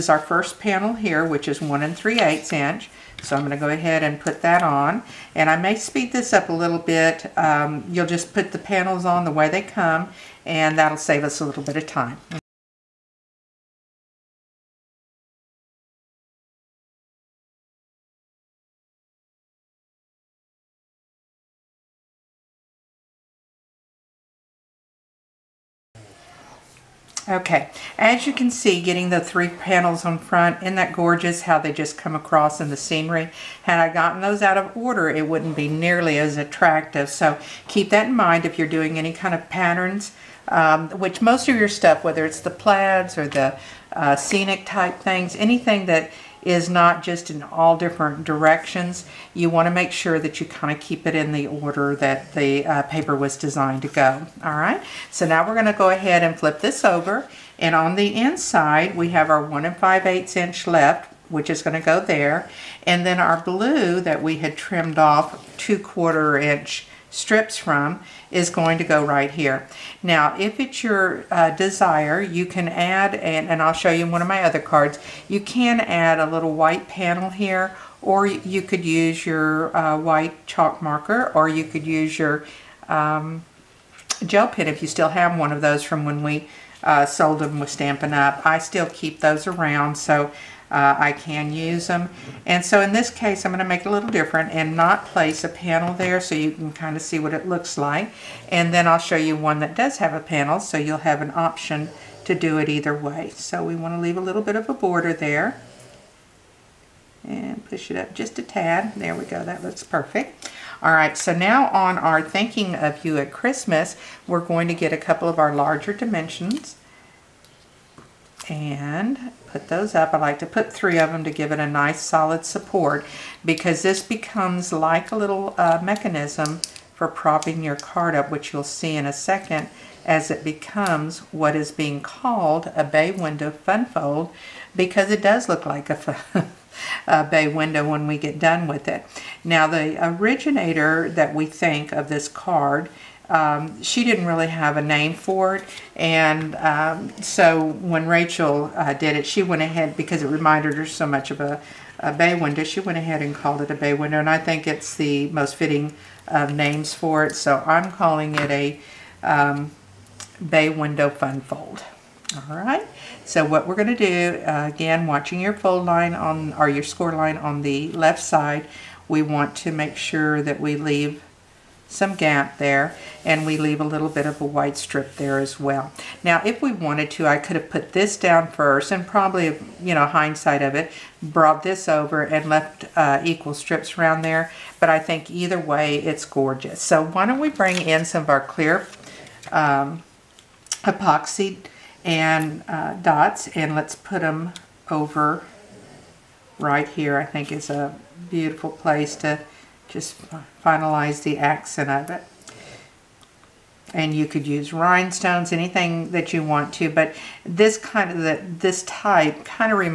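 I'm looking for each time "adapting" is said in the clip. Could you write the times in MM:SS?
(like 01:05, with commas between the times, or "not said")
not said.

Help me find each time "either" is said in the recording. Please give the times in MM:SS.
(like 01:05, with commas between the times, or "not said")
01:42, 03:05.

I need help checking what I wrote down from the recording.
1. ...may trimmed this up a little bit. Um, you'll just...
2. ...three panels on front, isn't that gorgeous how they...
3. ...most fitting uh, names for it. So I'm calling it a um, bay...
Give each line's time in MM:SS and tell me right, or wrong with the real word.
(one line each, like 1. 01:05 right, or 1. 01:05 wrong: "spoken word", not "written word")
1. 00:05 wrong: "speed", not "trimmed"
2. 00:29 right
3. 02:35 right.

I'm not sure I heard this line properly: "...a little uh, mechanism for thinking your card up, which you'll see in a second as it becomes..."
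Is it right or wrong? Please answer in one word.
wrong.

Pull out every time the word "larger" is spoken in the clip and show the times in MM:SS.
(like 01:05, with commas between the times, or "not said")
01:55.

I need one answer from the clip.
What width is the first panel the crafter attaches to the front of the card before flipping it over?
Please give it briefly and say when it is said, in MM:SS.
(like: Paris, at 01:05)
1 3/8 inch, at 00:01.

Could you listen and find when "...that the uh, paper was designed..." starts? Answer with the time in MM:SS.
00:51.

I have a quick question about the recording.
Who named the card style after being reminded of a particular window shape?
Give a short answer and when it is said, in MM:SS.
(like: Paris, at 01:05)
Rachel, at 02:28.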